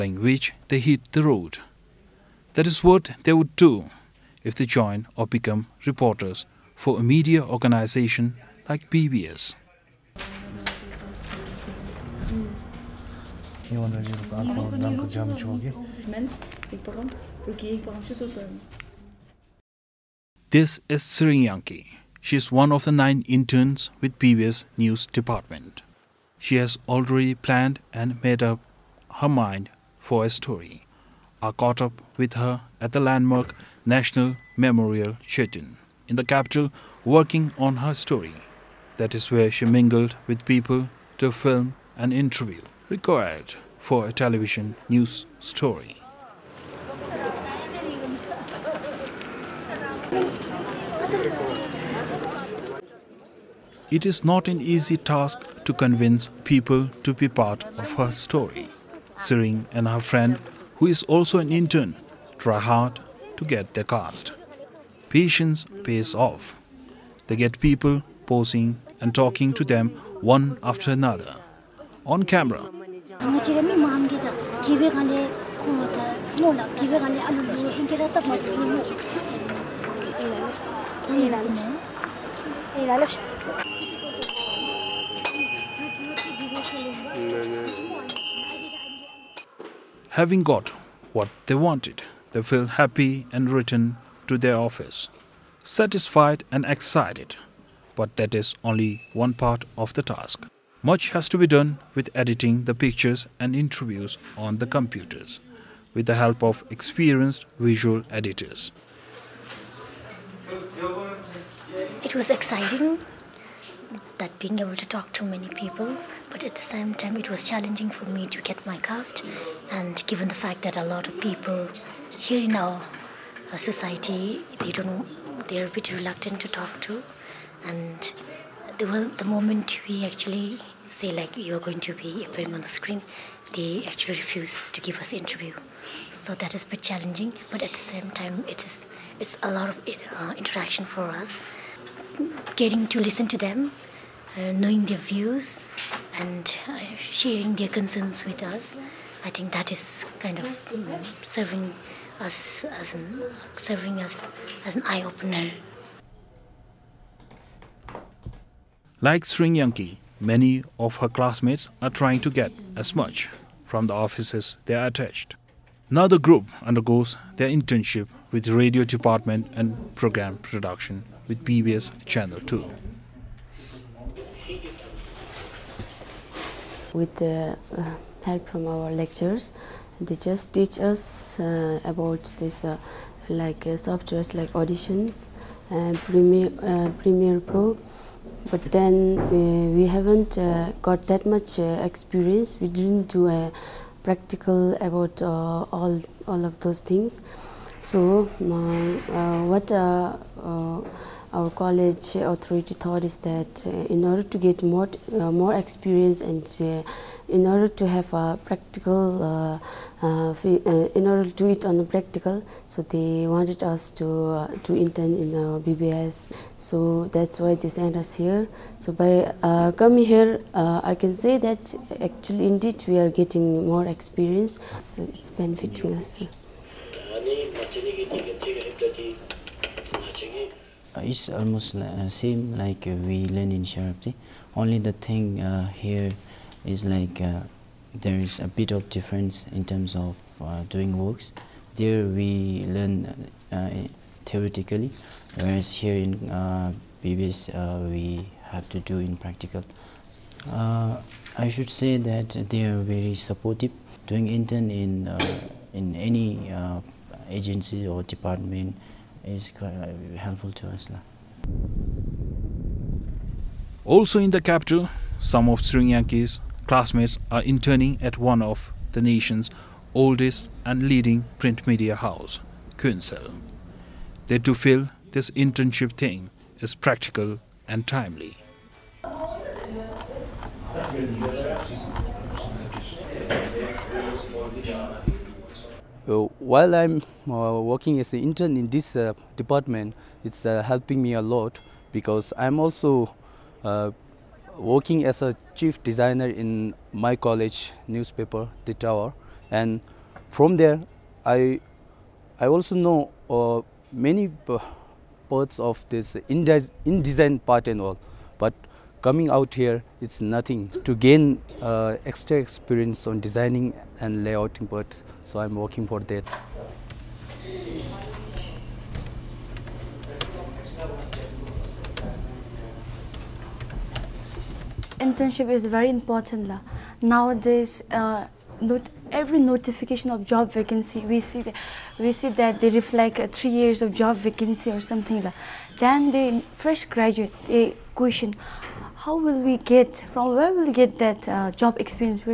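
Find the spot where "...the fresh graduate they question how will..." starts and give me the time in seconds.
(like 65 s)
336 s.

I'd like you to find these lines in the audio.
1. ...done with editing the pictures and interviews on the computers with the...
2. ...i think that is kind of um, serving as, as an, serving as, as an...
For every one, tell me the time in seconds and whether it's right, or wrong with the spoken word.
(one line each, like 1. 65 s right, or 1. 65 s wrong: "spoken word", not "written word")
1. 101 s right
2. 149 s right.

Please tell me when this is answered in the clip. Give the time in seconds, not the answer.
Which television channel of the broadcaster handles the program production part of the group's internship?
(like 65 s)
171 s.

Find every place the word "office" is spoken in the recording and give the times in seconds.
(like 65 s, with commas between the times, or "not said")
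94 s, 163 s.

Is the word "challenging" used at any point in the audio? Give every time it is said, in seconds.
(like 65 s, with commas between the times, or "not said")
117 s, 136 s.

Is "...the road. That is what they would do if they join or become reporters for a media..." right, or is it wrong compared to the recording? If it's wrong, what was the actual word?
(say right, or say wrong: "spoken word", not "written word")
right.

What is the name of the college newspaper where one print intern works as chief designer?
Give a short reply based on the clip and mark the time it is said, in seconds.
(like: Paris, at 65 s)
The Tower, at 298 s.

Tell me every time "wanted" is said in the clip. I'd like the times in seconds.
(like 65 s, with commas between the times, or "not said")
91 s, 213 s.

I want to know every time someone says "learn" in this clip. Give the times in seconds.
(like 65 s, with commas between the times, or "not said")
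233 s, 242 s.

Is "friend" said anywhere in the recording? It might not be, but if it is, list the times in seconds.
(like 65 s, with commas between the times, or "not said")
59 s.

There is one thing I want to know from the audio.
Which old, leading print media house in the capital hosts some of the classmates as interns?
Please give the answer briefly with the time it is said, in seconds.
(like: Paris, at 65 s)
Kuensel, at 272 s.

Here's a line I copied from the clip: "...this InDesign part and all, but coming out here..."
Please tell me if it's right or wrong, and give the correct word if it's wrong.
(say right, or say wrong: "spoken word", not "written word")
right.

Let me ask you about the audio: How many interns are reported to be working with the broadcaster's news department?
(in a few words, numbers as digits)
9.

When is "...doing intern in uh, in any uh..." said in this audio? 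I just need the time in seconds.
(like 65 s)
254 s.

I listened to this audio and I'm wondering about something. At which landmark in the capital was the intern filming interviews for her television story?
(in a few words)
National Memorial Shrine.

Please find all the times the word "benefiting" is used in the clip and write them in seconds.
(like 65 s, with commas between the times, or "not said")
225 s.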